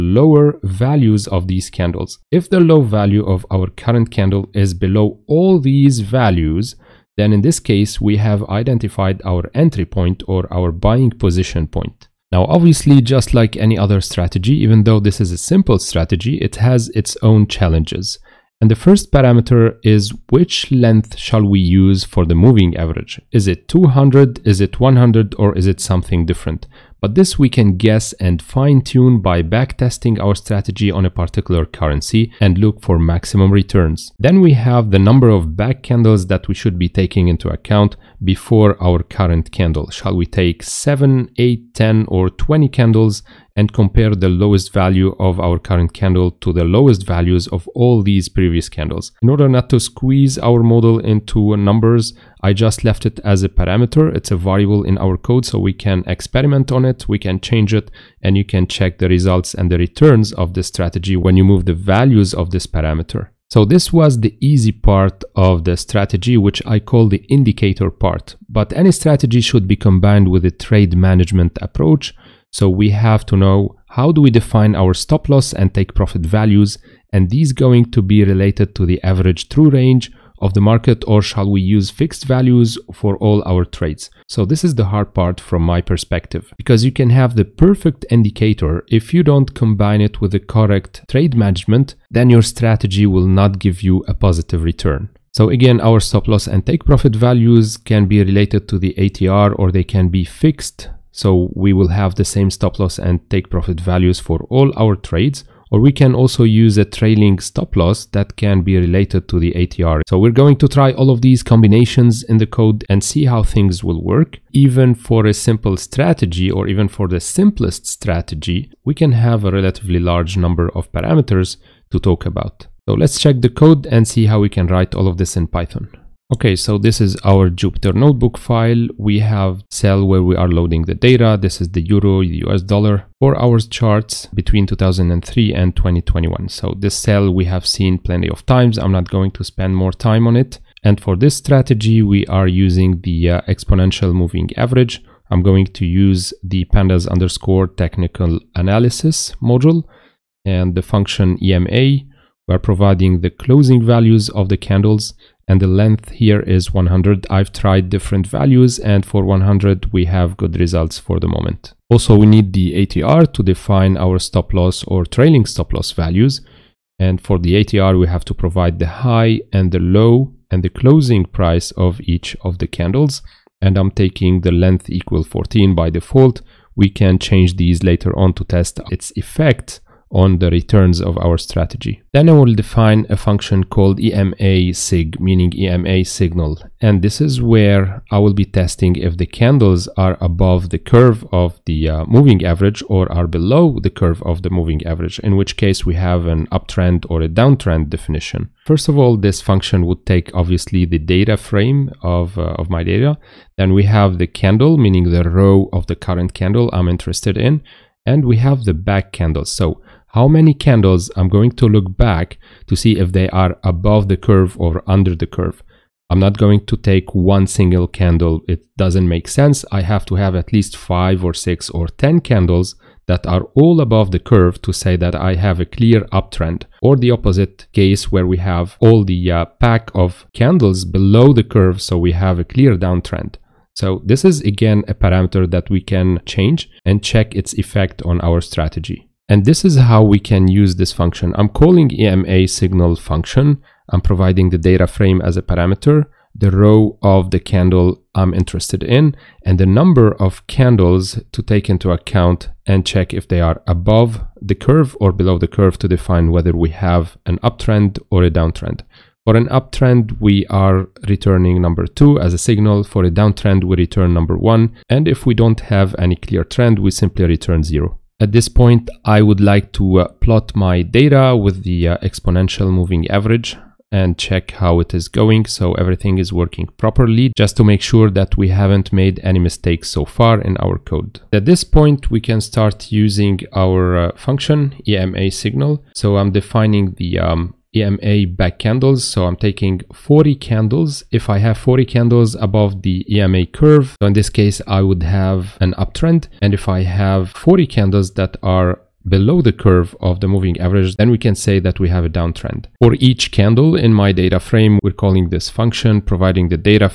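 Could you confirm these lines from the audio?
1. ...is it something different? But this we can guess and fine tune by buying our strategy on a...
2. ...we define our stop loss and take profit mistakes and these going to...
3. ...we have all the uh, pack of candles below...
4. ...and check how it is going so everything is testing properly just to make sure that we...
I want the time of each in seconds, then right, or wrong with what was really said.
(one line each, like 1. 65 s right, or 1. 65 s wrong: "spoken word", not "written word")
1. 25 s wrong: "backtesting", not "buying"
2. 74 s wrong: "values", not "mistakes"
3. 228 s right
4. 273 s wrong: "working", not "testing".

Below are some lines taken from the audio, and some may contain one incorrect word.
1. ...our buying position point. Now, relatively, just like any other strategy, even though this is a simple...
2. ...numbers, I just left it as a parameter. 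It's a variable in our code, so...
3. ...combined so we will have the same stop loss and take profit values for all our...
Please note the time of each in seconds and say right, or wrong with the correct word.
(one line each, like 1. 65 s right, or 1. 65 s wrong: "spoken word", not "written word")
1. 10 s wrong: "obviously", not "relatively"
2. 51 s right
3. 100 s wrong: "fixed", not "combined".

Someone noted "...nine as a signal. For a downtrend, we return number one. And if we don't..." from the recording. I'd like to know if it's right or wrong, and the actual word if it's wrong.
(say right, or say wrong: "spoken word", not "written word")
wrong: "two", not "nine".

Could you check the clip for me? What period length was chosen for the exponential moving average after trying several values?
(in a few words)
100.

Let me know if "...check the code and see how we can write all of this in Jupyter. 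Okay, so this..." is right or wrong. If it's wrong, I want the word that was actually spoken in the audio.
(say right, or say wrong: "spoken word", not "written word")
wrong: "Python", not "Jupyter".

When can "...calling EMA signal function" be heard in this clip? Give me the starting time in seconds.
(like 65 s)
241 s.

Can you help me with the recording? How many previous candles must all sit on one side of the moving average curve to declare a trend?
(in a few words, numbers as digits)
40.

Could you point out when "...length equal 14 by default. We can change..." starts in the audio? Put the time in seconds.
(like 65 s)
174 s.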